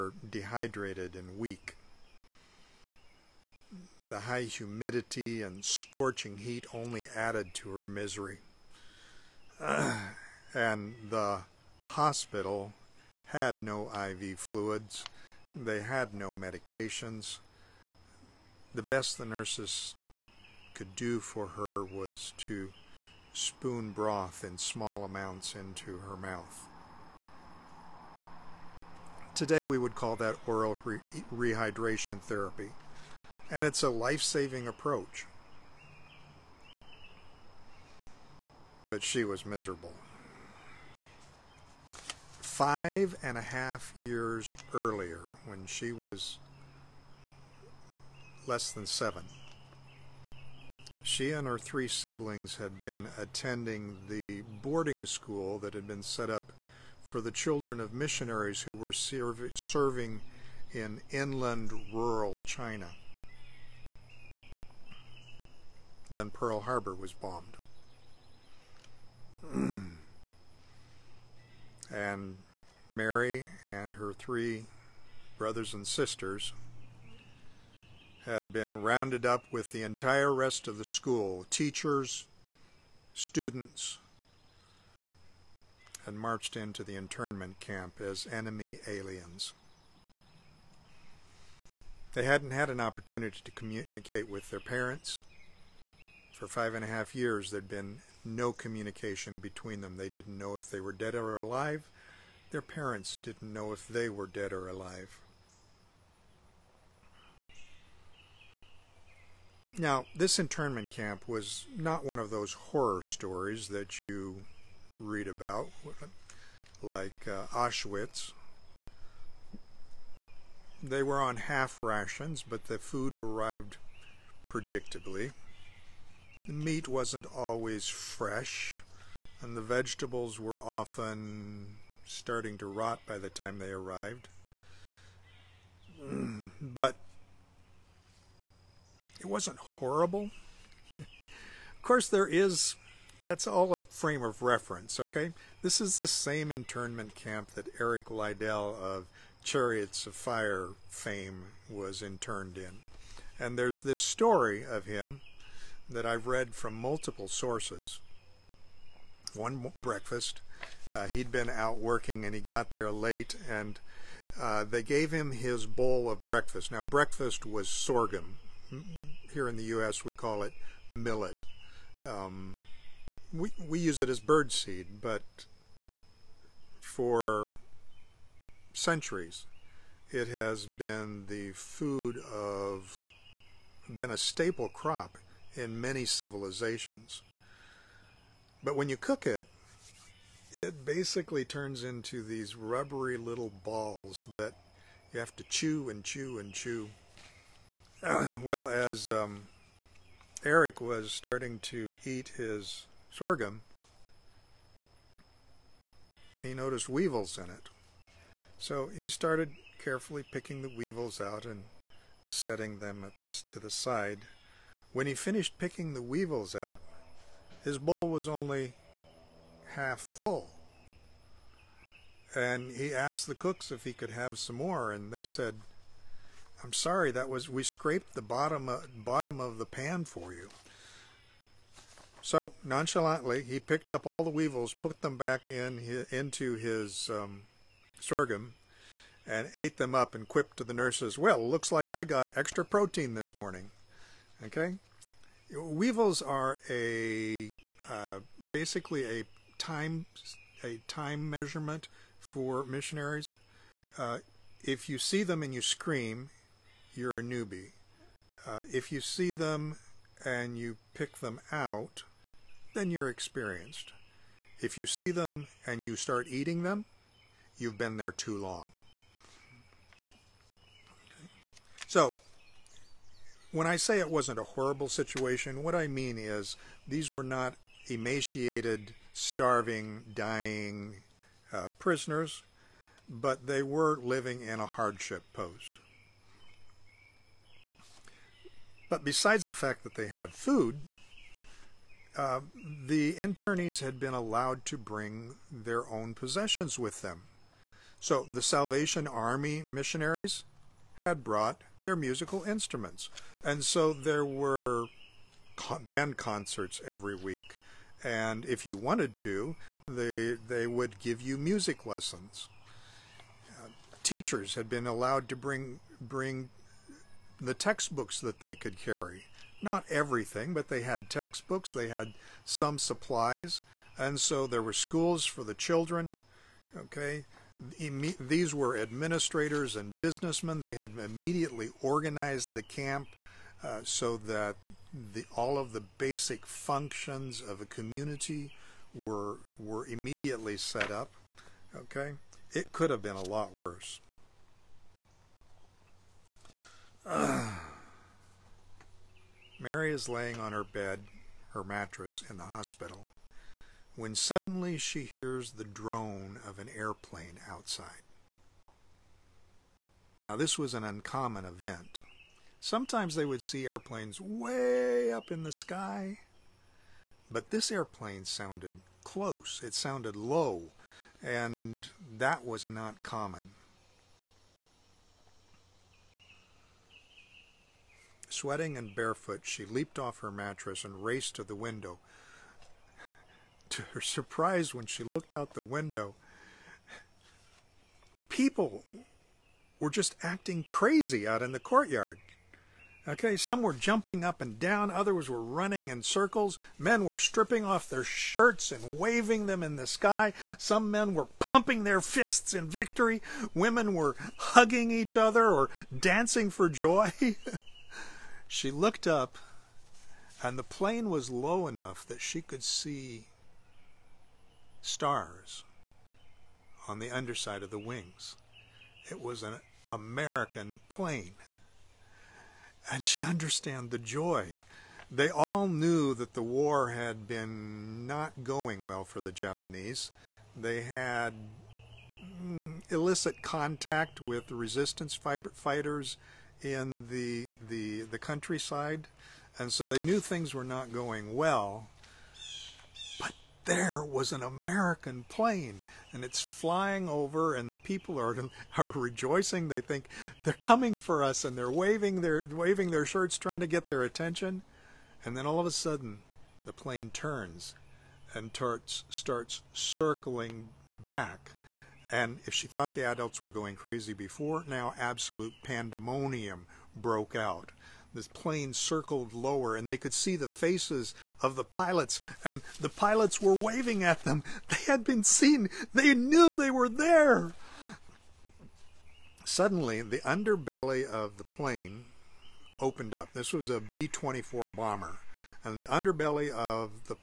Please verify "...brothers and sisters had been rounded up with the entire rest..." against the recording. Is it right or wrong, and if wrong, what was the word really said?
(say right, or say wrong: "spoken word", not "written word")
right.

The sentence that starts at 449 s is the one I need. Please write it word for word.
They think they're coming for us, and they're waving their, waving their shirts, trying to get their attention.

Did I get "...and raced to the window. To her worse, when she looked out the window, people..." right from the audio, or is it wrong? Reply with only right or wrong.
wrong.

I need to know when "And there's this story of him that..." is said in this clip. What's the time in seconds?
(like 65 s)
153 s.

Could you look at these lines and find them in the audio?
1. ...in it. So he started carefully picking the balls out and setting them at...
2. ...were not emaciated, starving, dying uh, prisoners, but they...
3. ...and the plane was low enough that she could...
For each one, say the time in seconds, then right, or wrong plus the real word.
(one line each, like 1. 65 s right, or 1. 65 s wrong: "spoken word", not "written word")
1. 207 s wrong: "weevils", not "balls"
2. 277 s right
3. 410 s right.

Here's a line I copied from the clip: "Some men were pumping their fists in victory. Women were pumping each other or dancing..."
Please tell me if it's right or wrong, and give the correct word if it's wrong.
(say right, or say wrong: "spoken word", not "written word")
wrong: "hugging", not "pumping".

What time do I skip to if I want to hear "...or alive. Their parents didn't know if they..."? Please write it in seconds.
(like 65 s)
101 s.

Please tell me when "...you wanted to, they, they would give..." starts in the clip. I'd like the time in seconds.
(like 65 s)
308 s.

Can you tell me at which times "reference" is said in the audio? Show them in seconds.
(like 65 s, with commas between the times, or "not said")
144 s.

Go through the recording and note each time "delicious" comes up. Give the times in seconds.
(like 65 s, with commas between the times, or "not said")
not said.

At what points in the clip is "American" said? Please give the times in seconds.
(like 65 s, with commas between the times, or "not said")
419 s, 444 s.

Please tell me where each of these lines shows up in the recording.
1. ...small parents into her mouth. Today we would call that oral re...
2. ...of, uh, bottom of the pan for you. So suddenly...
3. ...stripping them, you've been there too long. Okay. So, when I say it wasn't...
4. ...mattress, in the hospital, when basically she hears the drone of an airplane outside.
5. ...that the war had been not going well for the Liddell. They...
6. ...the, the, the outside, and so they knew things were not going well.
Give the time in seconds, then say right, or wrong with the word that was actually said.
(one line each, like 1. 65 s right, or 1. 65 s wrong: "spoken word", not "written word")
1. 24 s wrong: "amounts", not "parents"
2. 228 s wrong: "nonchalantly", not "suddenly"
3. 266 s wrong: "eating", not "stripping"
4. 351 s wrong: "suddenly", not "basically"
5. 426 s wrong: "Japanese", not "Liddell"
6. 437 s wrong: "countryside", not "outside".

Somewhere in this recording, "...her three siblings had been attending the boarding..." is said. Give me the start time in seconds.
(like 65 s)
51 s.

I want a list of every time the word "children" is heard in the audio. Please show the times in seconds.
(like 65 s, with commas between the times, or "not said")
57 s, 325 s.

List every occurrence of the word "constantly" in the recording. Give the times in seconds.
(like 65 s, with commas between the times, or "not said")
not said.